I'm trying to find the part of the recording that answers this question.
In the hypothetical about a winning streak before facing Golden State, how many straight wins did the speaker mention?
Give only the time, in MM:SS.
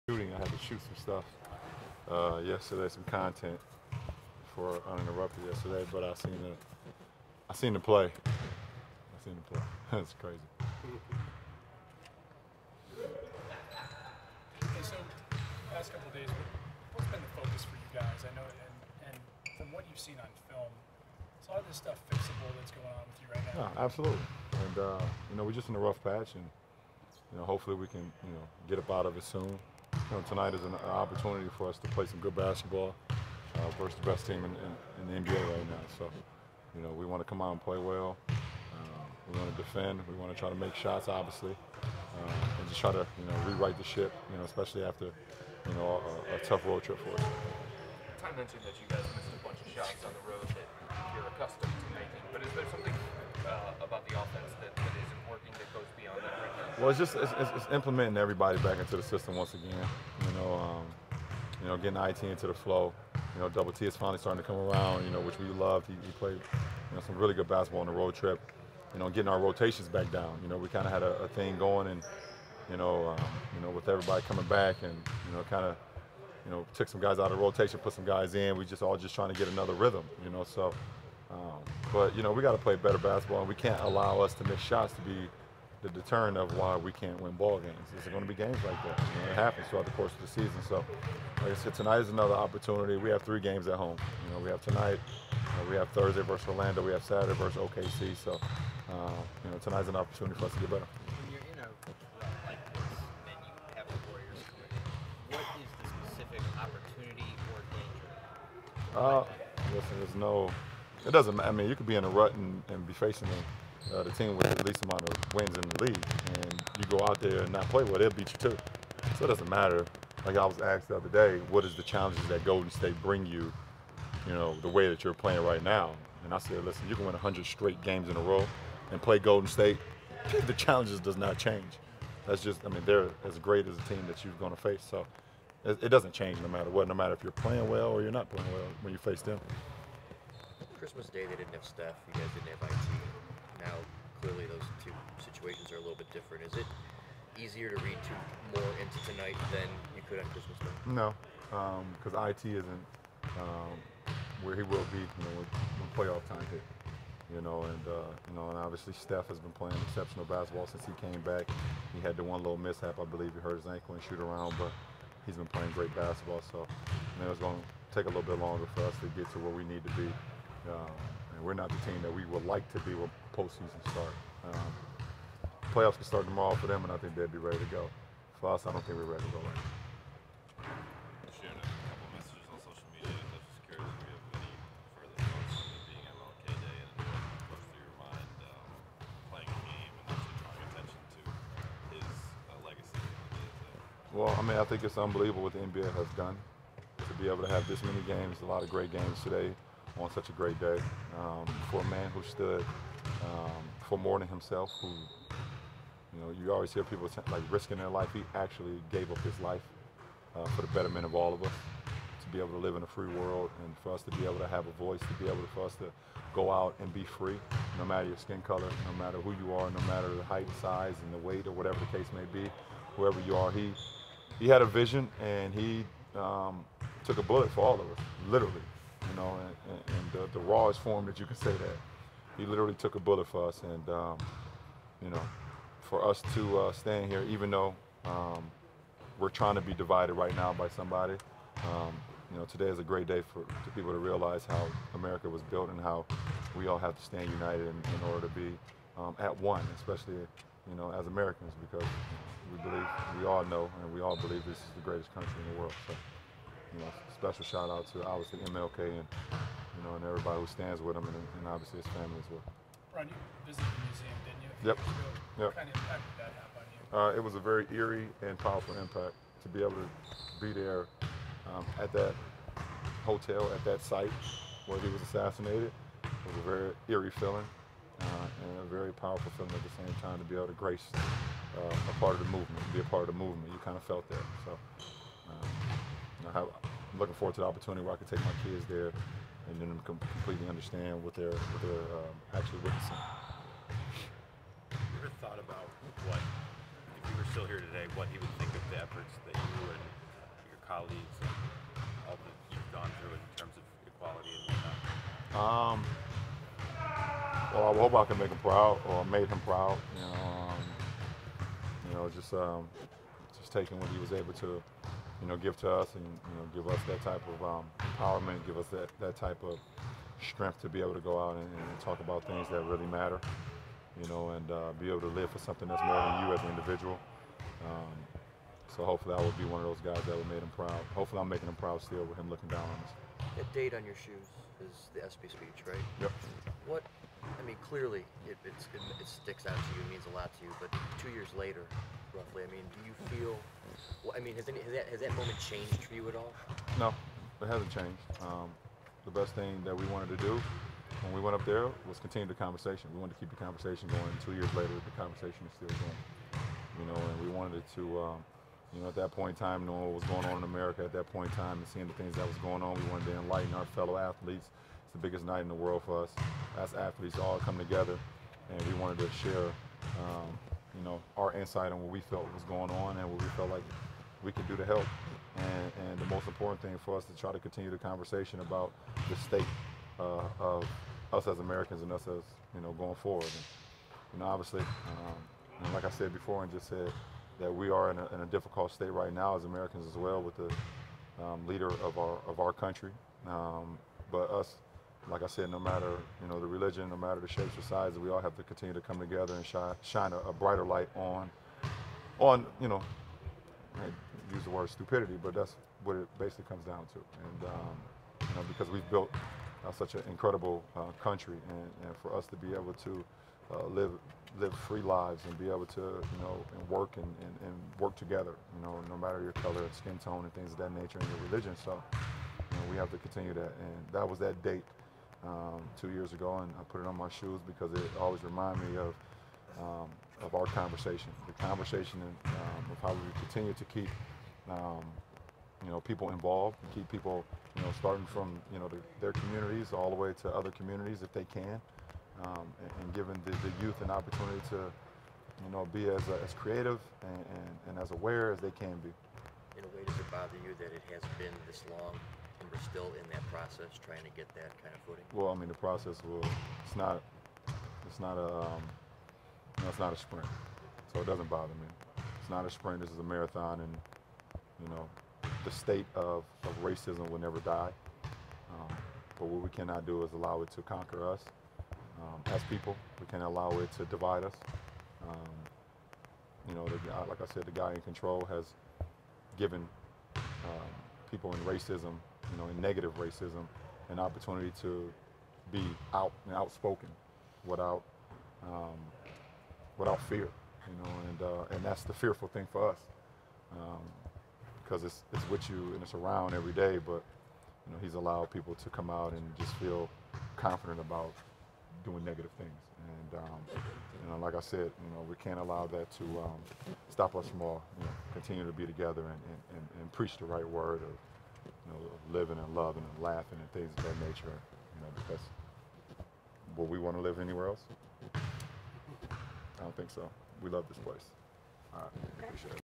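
02:07.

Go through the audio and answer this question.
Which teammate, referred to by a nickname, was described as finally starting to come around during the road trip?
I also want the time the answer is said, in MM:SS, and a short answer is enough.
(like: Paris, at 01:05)
Double T, at 01:03.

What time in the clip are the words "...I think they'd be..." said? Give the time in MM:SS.
02:56.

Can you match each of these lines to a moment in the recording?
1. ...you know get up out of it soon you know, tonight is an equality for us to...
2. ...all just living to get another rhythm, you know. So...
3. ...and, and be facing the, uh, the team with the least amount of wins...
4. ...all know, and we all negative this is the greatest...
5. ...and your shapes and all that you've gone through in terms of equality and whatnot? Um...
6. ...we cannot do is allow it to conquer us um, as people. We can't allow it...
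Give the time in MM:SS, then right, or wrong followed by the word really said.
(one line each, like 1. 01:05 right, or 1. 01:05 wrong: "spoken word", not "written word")
1. 00:28 wrong: "opportunity", not "equality"
2. 01:18 wrong: "trying", not "living"
3. 01:52 right
4. 04:13 wrong: "believe", not "negative"
5. 04:59 wrong: "colleagues", not "shapes"
6. 07:49 right.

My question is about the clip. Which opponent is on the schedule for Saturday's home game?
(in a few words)
OKC.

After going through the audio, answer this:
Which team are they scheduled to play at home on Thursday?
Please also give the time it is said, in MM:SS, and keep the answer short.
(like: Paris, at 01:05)
Orlando, at 01:36.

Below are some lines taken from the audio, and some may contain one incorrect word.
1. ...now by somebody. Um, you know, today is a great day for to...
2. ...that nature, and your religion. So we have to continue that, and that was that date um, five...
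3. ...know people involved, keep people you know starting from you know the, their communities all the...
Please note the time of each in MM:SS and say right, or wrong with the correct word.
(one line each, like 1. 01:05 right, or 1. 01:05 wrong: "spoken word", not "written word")
1. 04:00 right
2. 07:00 wrong: "two", not "five"
3. 07:15 right.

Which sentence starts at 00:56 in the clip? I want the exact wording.
Well, it's just it's, it's, it's implementing everybody back into the system once again.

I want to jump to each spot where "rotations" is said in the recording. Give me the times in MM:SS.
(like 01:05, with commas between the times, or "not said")
01:09, 01:17.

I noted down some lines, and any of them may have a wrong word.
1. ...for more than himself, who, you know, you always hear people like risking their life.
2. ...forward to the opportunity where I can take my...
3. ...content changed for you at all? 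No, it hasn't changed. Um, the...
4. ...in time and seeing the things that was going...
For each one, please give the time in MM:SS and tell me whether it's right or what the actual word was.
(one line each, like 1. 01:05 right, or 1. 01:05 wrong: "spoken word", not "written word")
1. 03:23 right
2. 04:47 right
3. 05:45 wrong: "moment", not "content"
4. 06:01 right.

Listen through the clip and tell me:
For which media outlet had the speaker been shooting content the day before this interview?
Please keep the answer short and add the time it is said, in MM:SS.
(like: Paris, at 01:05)
Uninterrupted, at 00:04.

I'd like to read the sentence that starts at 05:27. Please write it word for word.
Um, so hopefully, I will be one of those guys that will make him proud.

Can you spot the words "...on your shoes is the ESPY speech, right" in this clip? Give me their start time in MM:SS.
05:33.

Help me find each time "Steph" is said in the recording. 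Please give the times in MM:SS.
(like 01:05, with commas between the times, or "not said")
02:21, 02:38.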